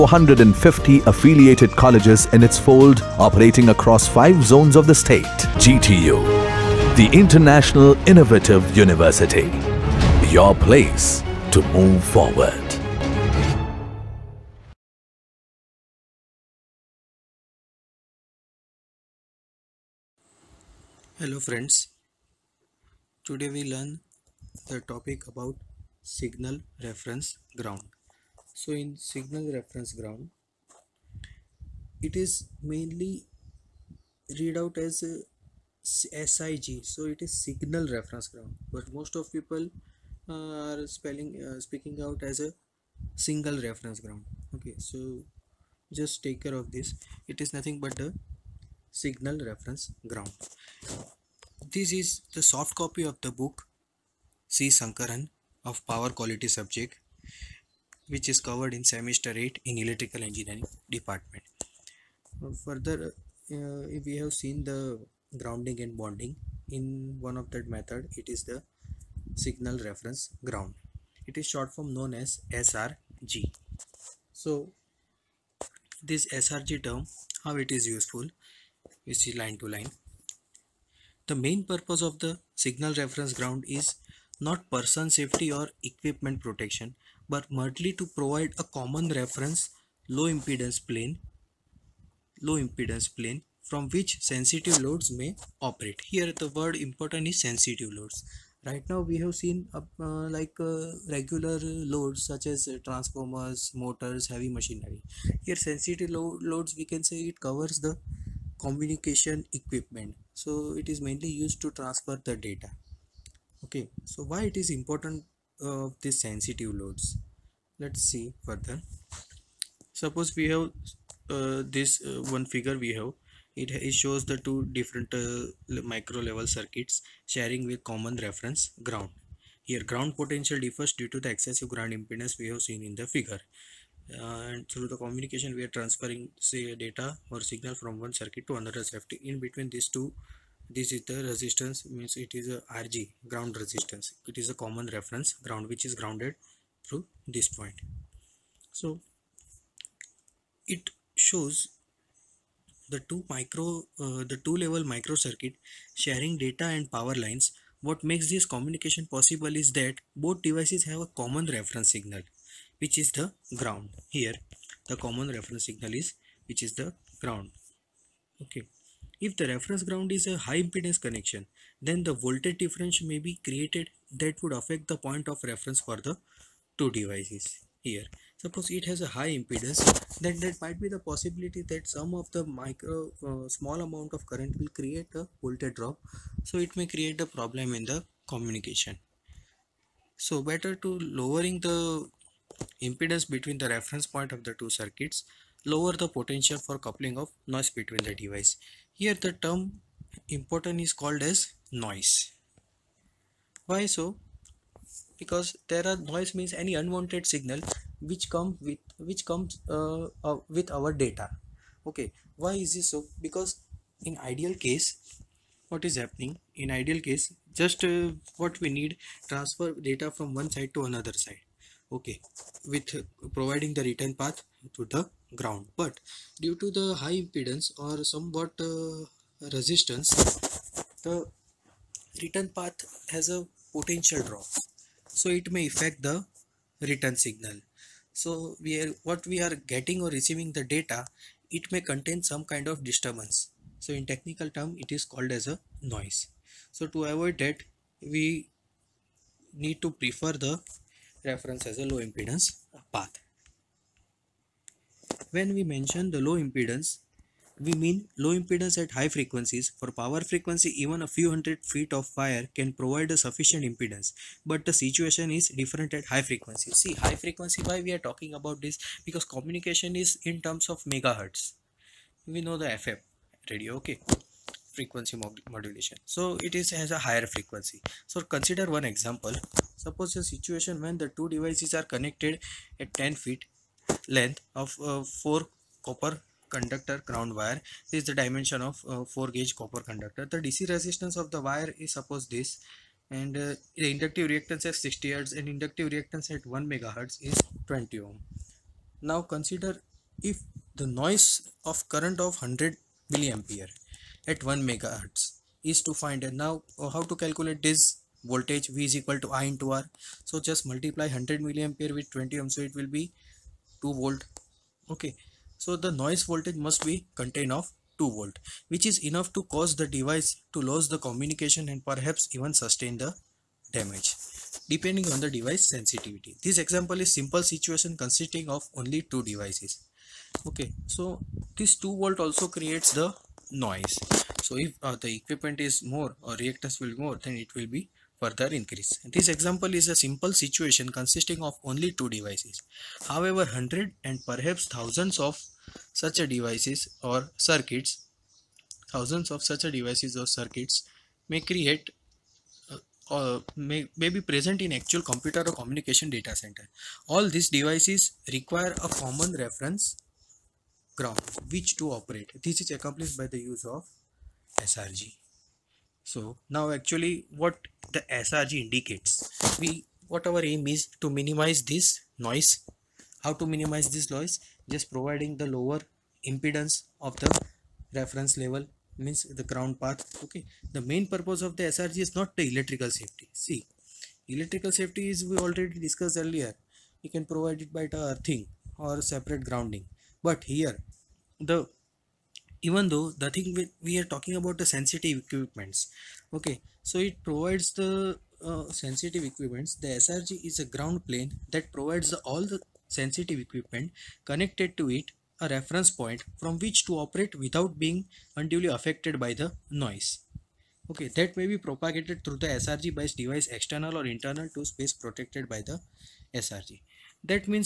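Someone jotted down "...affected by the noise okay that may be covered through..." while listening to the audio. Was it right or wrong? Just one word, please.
wrong.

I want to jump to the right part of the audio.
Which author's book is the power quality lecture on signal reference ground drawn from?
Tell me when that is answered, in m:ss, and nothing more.
0:54.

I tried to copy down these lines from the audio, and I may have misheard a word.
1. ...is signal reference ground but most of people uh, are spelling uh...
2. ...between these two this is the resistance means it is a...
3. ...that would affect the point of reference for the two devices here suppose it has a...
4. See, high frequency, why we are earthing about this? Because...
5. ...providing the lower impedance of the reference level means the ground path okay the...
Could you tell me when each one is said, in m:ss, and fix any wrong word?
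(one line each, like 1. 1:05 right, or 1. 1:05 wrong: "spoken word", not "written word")
1. 0:37 right
2. 2:19 right
3. 2:54 right
4. 4:26 wrong: "talking", not "earthing"
5. 6:14 right.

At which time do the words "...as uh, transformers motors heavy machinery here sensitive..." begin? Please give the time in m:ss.
1:42.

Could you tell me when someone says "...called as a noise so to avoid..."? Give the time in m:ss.
4:05.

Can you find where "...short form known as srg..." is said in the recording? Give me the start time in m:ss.
1:11.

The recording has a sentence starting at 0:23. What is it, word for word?
Today we learn the topic about signal reference ground.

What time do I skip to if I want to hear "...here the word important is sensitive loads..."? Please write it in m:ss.
1:36.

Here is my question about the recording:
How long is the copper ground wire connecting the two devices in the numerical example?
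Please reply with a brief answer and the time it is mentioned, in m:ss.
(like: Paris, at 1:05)
10 feet, at 4:42.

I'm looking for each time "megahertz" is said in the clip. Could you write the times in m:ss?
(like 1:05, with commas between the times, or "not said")
4:30, 4:56, 5:04.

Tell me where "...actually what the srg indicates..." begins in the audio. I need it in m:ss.
6:06.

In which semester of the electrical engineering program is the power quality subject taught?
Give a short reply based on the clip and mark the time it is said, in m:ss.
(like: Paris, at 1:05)
semester 8, at 0:58.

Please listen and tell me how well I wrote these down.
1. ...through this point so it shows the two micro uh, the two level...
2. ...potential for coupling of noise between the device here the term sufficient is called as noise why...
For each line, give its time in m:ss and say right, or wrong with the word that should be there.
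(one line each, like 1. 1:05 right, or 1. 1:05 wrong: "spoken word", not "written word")
1. 2:26 right
2. 3:16 wrong: "important", not "sufficient".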